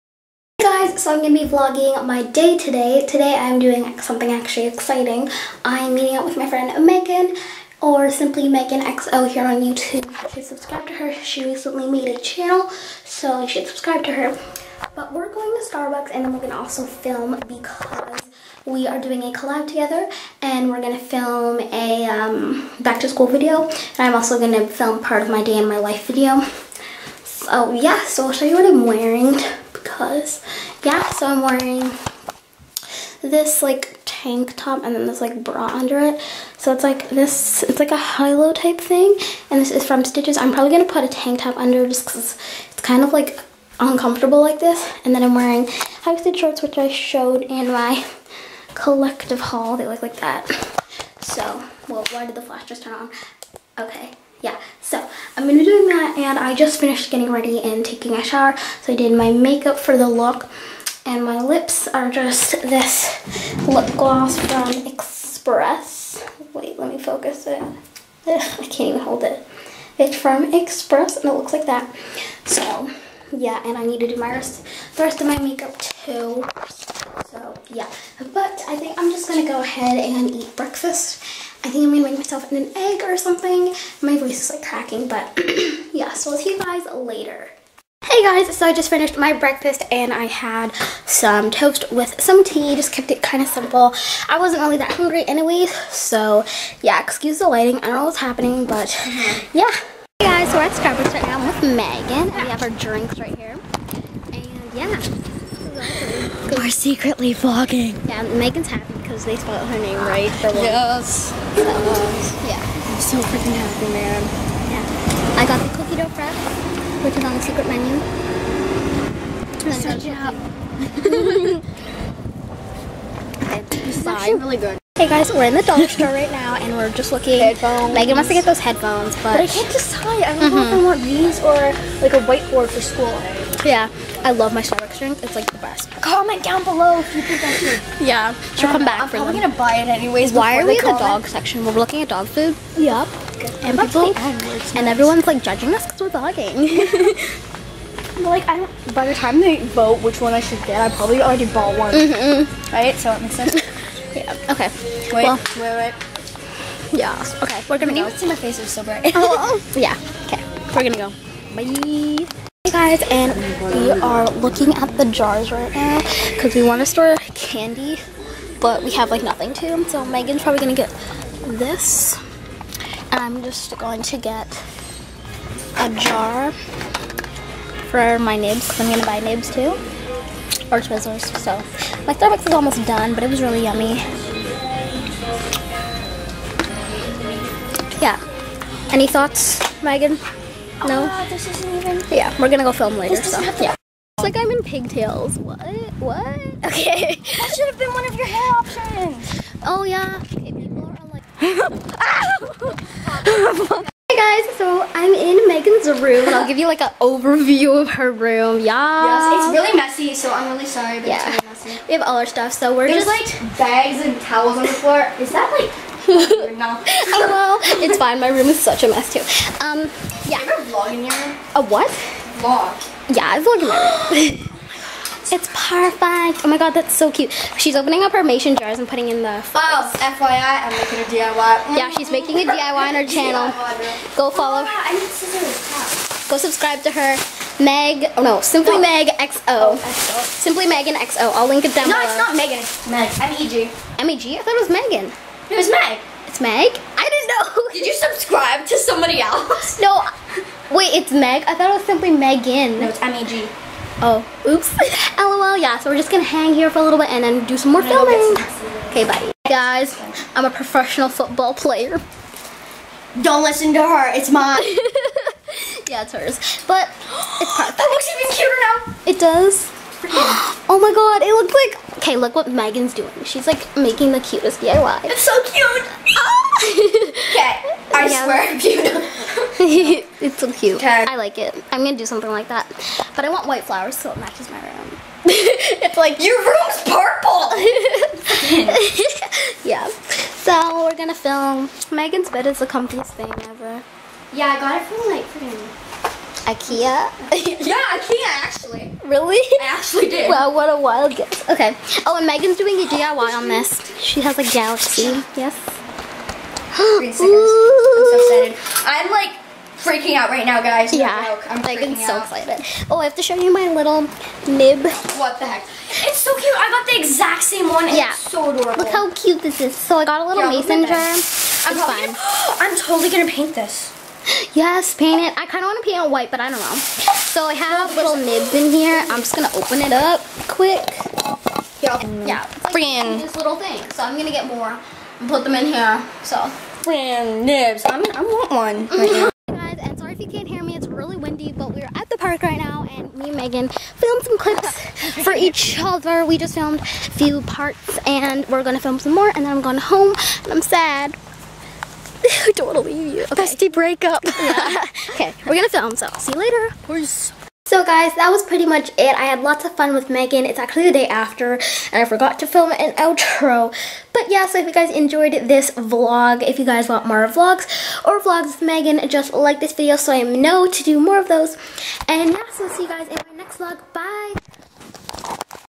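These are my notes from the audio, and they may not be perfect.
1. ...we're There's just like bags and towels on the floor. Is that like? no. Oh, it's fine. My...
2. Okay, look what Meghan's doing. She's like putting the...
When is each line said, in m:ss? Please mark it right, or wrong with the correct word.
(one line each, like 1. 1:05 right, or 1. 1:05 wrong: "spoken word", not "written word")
1. 3:32 right
2. 4:31 wrong: "making", not "putting".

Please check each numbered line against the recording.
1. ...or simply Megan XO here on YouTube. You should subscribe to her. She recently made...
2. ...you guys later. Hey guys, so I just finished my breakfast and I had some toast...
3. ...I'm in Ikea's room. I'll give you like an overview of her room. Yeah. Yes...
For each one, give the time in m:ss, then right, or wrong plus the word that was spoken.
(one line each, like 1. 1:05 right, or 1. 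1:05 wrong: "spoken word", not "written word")
1. 0:07 right
2. 1:26 right
3. 3:24 wrong: "Meghan", not "Ikea".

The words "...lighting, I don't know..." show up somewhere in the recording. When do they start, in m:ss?
1:37.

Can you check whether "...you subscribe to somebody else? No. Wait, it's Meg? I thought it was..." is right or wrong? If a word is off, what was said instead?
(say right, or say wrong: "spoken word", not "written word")
right.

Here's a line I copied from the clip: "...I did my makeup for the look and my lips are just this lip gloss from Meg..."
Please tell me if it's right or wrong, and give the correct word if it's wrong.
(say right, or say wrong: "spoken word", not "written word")
wrong: "Express", not "Meg".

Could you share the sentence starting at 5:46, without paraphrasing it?
We just filmed a few parts, and we're gonna film some more, and then I'm going home, and I'm sad.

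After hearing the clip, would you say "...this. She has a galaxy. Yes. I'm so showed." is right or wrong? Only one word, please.
wrong.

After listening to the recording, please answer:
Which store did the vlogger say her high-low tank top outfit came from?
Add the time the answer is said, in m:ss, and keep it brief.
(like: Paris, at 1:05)
Stitches, at 0:40.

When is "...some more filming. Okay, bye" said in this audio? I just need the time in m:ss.
4:17.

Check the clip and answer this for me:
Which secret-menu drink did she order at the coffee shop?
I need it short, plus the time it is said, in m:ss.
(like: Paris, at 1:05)
cookie dough frap, at 1:55.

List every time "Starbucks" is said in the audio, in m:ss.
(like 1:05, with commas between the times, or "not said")
0:15, 1:40, 2:14, 3:02.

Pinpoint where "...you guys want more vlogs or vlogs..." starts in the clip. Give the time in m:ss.
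6:06.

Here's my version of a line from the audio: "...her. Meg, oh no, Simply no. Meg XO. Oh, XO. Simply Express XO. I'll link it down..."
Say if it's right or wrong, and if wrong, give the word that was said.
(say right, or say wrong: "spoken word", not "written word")
wrong: "Megan", not "Express".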